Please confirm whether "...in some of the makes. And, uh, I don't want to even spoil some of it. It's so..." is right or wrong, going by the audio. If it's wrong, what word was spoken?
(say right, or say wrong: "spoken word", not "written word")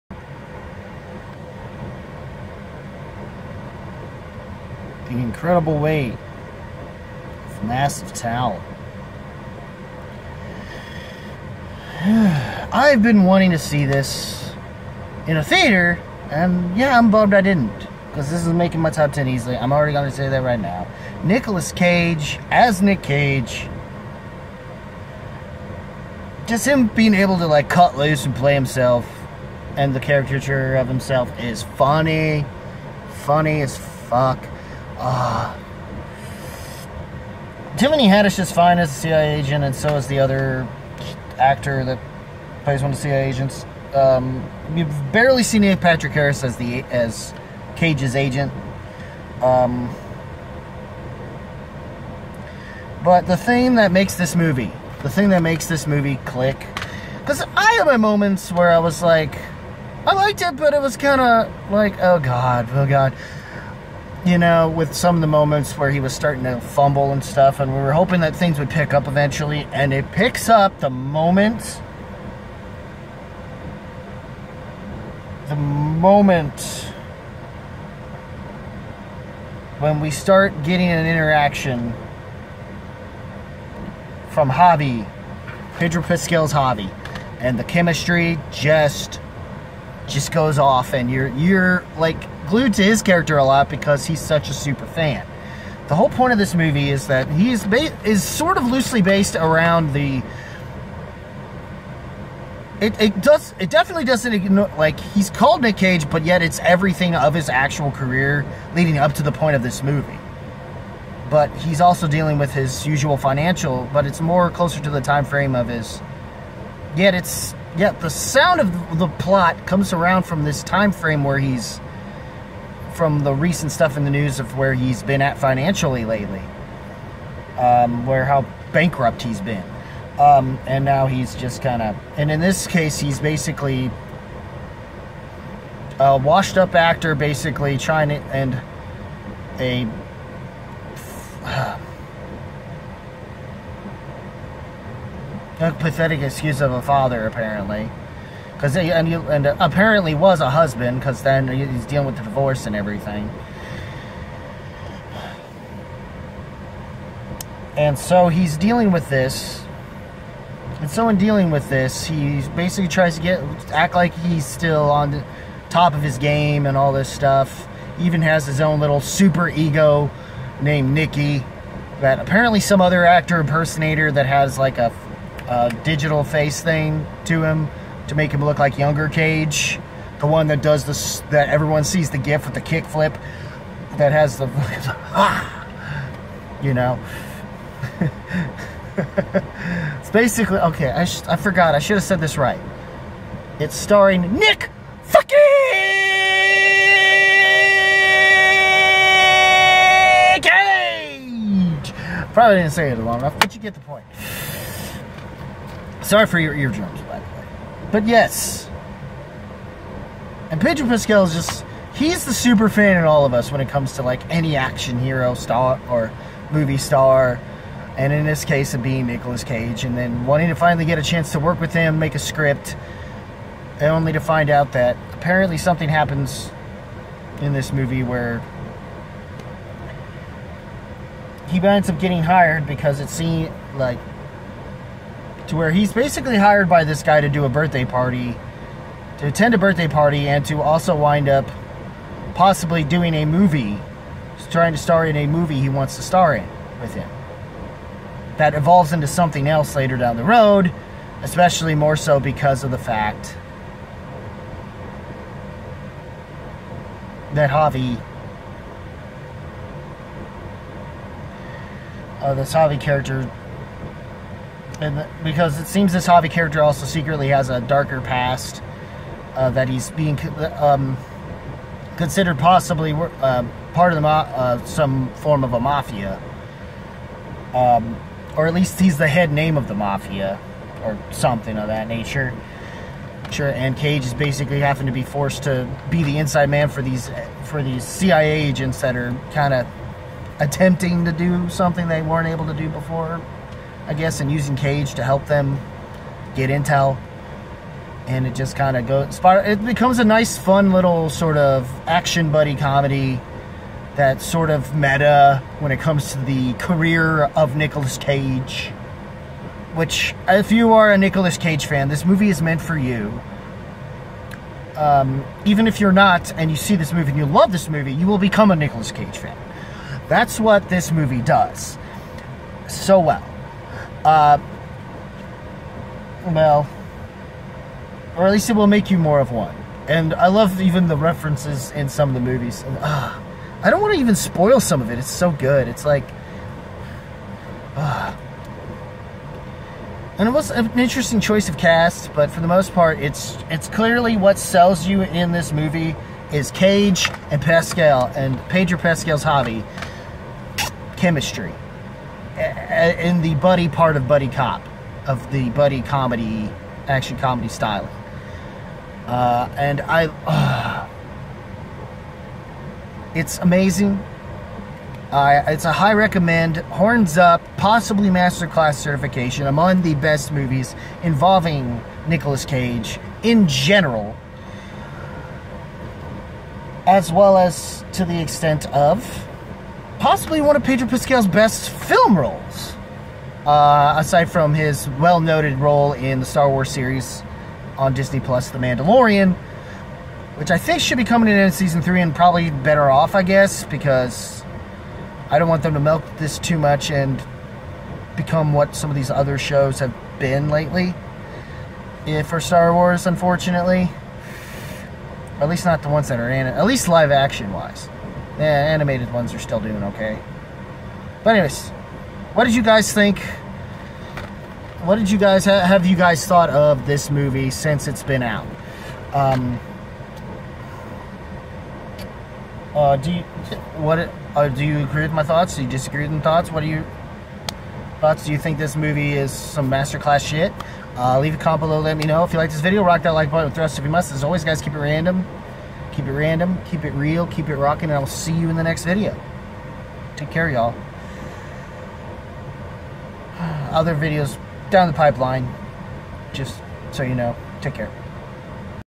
wrong: "movies", not "makes".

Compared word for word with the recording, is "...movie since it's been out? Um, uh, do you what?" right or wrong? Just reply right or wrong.
right.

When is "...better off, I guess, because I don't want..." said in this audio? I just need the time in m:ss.
6:32.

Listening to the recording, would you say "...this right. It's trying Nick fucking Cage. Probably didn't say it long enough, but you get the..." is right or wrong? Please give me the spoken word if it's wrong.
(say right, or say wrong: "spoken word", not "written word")
wrong: "starring", not "trying".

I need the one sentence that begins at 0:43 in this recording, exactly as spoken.
Um, you've barely seen Neil Patrick Harris as the as Cage's agent.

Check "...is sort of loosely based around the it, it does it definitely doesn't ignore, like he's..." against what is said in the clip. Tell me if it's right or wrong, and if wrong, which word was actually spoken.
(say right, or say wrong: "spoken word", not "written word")
right.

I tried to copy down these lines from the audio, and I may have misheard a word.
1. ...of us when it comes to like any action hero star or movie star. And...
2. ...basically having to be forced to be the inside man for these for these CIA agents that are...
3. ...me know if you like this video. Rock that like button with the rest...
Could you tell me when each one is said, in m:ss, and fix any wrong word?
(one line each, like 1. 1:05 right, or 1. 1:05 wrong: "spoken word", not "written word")
1. 3:33 right
2. 4:44 right
3. 7:11 right.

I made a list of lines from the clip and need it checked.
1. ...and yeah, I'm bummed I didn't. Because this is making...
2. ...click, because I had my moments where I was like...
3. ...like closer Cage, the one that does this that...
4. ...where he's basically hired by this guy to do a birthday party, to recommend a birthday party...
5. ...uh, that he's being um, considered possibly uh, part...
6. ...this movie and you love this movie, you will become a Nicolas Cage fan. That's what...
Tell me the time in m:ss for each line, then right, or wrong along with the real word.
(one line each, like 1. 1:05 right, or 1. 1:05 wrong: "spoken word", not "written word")
1. 0:16 right
2. 0:56 right
3. 2:58 wrong: "younger", not "closer"
4. 3:55 wrong: "attend", not "recommend"
5. 4:29 right
6. 5:16 right.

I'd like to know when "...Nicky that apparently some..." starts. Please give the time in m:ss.
2:50.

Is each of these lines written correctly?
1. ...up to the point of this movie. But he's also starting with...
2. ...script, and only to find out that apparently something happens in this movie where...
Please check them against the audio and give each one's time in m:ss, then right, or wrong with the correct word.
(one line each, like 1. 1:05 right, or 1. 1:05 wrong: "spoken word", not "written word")
1. 1:48 wrong: "dealing", not "starting"
2. 3:42 right.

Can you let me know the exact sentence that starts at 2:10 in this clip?
Um, and now he's just kind of, and in this case, he's basically a washed up actor, basically trying to, and a.